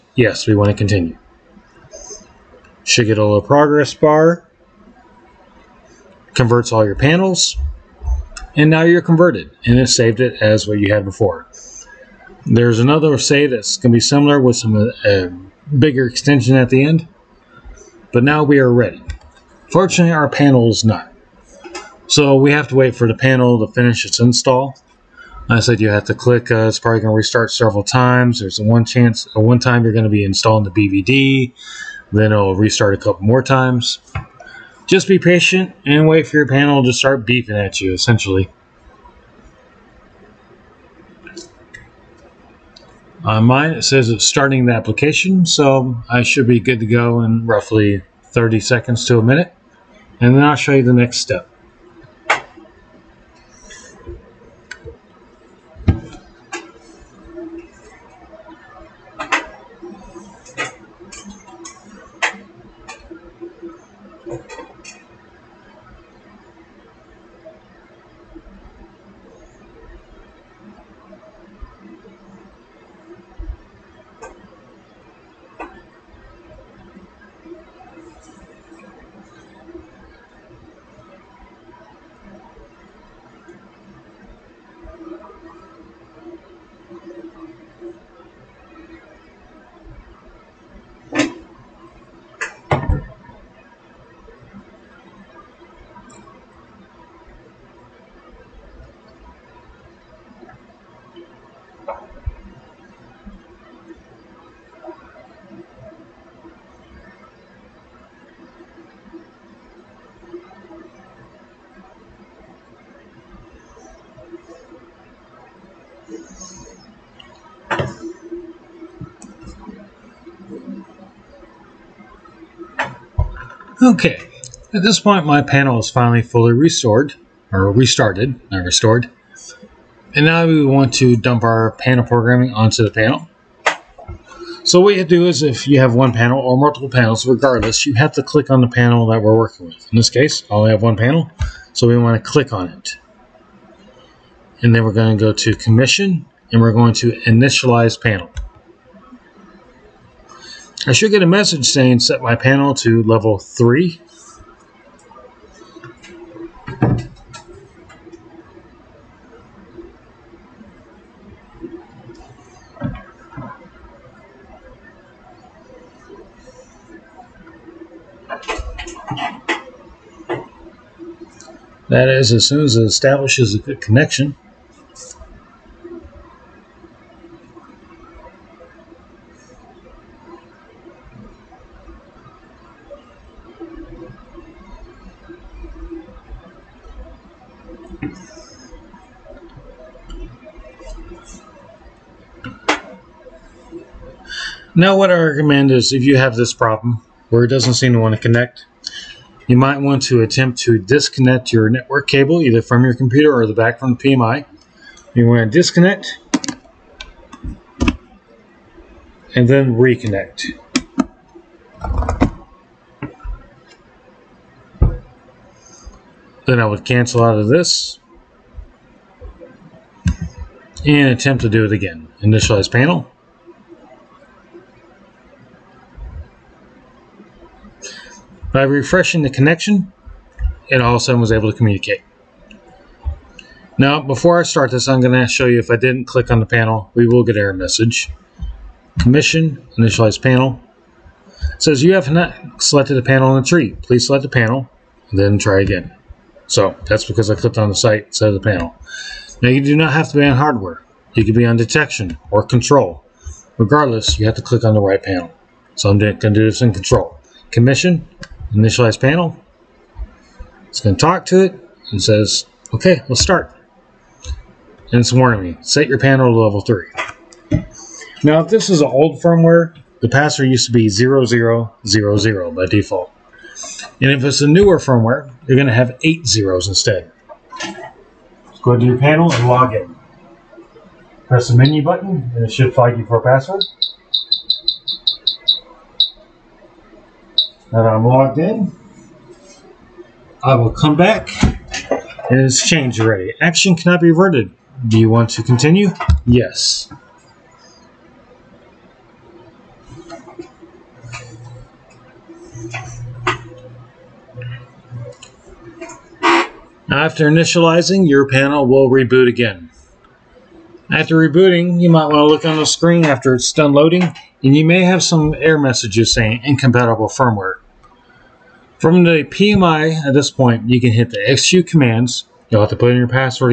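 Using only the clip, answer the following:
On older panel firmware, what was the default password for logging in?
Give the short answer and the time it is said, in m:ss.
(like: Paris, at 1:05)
0000, at 4:30.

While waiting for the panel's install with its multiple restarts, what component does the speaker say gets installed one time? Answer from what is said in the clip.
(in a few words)
BVD.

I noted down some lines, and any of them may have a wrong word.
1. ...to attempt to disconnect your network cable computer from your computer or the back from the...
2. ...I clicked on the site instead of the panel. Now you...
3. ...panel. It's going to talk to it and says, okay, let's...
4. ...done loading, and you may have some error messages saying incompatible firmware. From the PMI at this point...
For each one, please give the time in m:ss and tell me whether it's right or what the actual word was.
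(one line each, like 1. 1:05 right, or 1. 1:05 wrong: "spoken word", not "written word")
1. 3:20 wrong: "either", not "computer"
2. 4:07 right
3. 4:19 right
4. 5:13 right.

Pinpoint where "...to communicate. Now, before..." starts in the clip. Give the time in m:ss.
3:51.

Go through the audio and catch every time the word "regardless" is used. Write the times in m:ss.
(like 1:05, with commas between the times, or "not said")
2:17, 4:13.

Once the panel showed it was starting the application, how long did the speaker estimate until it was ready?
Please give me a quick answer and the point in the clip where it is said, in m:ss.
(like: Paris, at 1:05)
30 seconds to a minute, at 0:48.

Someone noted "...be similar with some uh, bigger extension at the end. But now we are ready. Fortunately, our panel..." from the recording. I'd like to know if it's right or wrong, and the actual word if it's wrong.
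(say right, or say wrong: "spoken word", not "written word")
right.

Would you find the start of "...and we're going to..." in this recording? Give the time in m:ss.
2:26.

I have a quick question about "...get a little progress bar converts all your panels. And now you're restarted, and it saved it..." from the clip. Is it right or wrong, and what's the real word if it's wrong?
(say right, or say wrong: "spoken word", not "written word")
wrong: "converted", not "restarted".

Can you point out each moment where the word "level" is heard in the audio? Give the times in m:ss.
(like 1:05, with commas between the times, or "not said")
2:33, 4:26.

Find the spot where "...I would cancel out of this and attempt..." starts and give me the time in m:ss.
3:36.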